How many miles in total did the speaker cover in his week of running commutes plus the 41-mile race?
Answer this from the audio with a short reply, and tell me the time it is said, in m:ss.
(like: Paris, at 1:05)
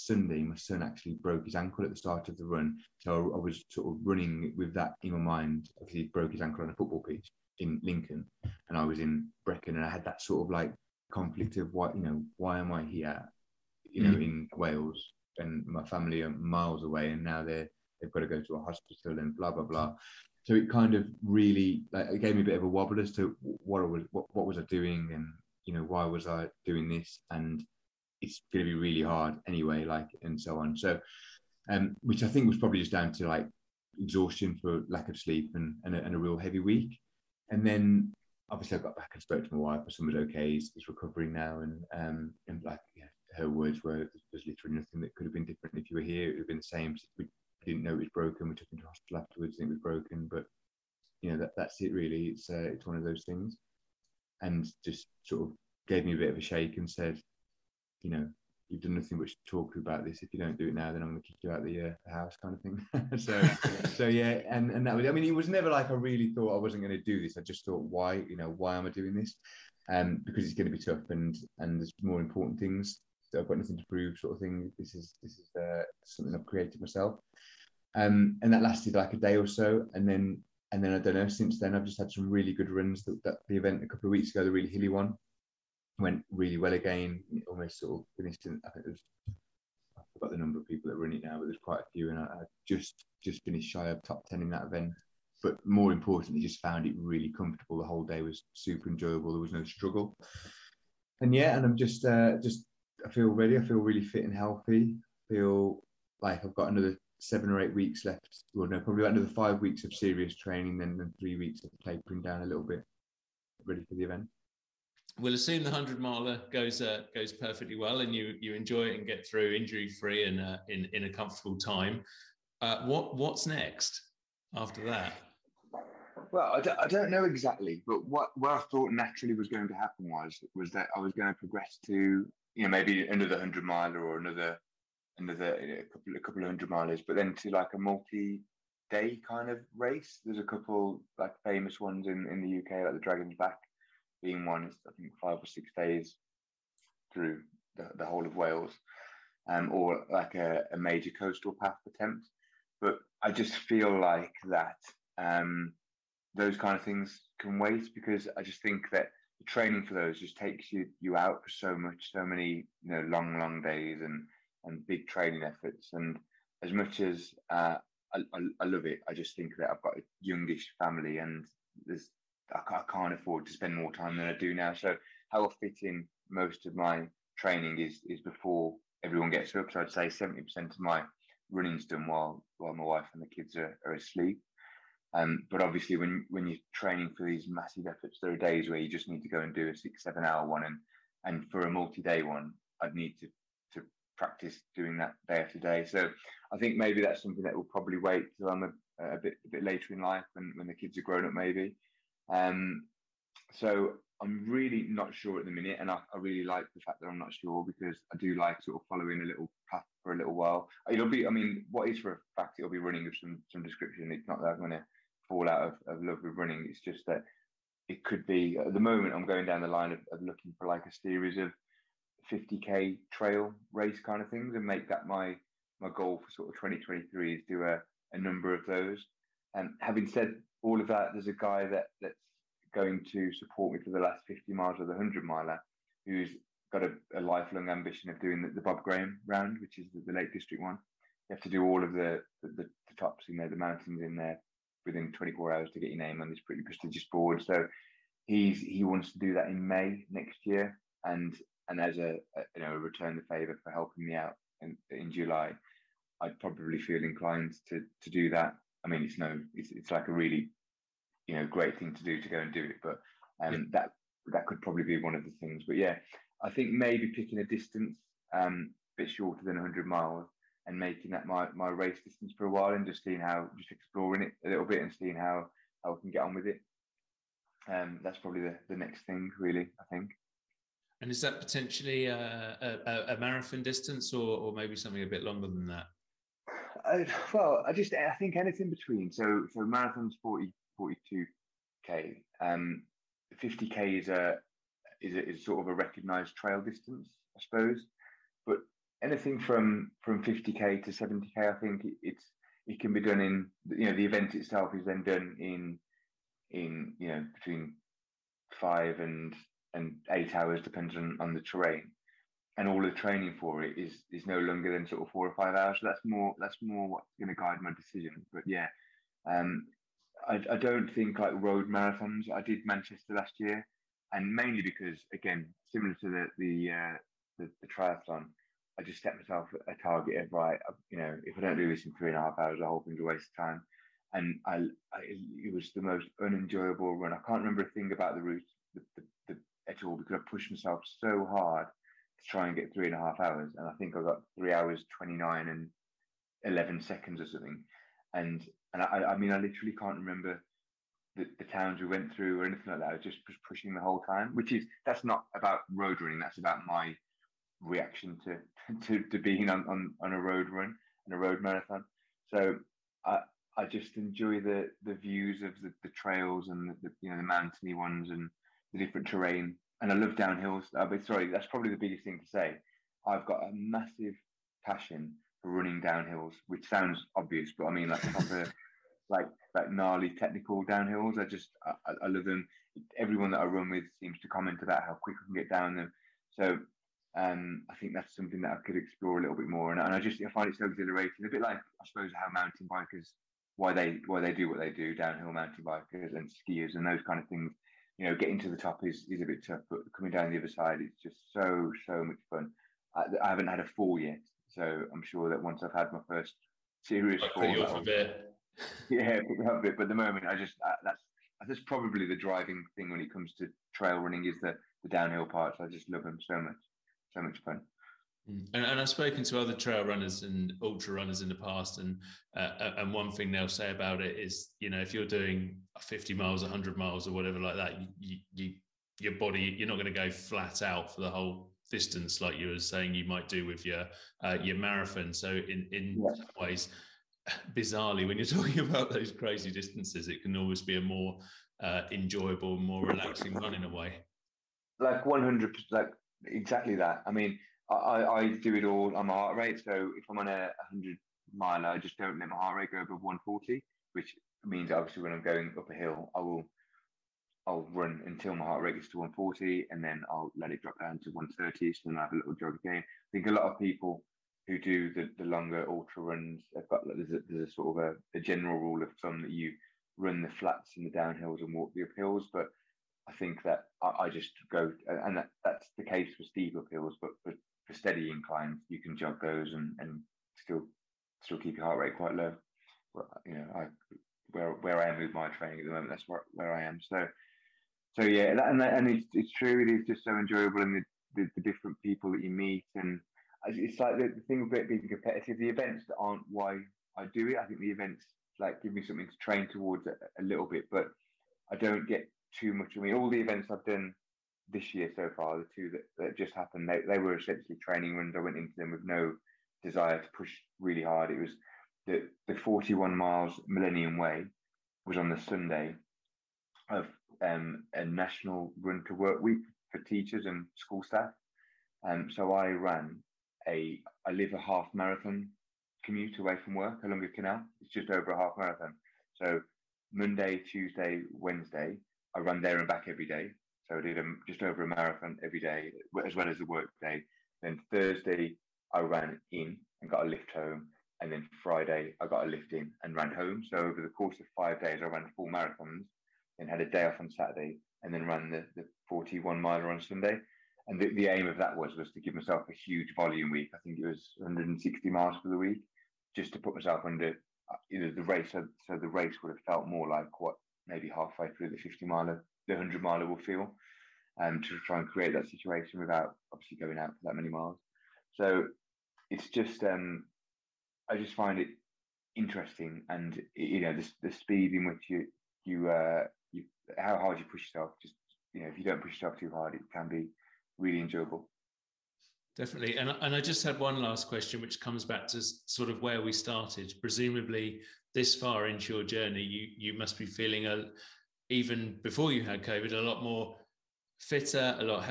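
160 miles, at 9:14.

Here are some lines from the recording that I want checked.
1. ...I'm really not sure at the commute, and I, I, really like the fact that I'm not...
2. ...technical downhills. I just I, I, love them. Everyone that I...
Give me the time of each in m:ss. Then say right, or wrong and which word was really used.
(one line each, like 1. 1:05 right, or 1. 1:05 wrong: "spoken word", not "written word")
1. 3:24 wrong: "minute", not "commute"
2. 6:20 right.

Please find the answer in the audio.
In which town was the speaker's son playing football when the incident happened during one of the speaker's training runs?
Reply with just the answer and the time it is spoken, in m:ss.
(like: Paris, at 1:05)
Lincoln, at 0:07.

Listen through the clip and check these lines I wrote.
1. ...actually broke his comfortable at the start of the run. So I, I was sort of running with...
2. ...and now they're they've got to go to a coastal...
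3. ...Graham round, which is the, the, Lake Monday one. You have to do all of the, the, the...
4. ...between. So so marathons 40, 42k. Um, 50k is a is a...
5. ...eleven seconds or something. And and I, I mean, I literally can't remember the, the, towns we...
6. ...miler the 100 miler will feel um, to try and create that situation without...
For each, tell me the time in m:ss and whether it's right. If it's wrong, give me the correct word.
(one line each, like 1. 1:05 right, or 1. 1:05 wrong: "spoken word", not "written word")
1. 0:00 wrong: "ankle", not "comfortable"
2. 0:17 wrong: "hospital", not "coastal"
3. 3:58 wrong: "District", not "Monday"
4. 4:48 right
5. 5:46 right
6. 9:21 right.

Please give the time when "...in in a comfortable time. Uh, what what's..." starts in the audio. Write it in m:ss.
2:00.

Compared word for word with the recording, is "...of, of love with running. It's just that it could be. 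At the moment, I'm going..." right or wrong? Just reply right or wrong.
right.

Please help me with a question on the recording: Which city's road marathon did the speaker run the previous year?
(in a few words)
Manchester.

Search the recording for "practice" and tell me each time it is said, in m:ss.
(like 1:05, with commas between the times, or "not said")
3:14.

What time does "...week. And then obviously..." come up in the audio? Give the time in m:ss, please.
0:36.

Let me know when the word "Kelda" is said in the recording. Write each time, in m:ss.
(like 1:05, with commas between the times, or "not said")
not said.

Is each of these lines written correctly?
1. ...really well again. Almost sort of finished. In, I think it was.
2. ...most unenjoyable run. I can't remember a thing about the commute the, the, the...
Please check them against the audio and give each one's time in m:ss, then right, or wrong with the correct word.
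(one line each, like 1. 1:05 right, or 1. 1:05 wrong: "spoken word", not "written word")
1. 1:26 right
2. 5:35 wrong: "route", not "commute".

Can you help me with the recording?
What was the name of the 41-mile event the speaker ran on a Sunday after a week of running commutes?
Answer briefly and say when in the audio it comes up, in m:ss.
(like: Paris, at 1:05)
Millennium Way, at 8:33.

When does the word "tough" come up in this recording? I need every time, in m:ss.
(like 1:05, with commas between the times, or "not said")
1:10, 6:39.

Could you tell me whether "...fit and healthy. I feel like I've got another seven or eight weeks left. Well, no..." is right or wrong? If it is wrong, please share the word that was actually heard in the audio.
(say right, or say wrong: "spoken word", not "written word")
right.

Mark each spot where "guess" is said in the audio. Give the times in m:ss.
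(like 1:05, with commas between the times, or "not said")
not said.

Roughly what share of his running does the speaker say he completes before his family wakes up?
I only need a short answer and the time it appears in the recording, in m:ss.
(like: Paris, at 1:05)
70 percent, at 3:00.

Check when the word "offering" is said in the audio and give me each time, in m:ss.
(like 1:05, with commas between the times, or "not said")
not said.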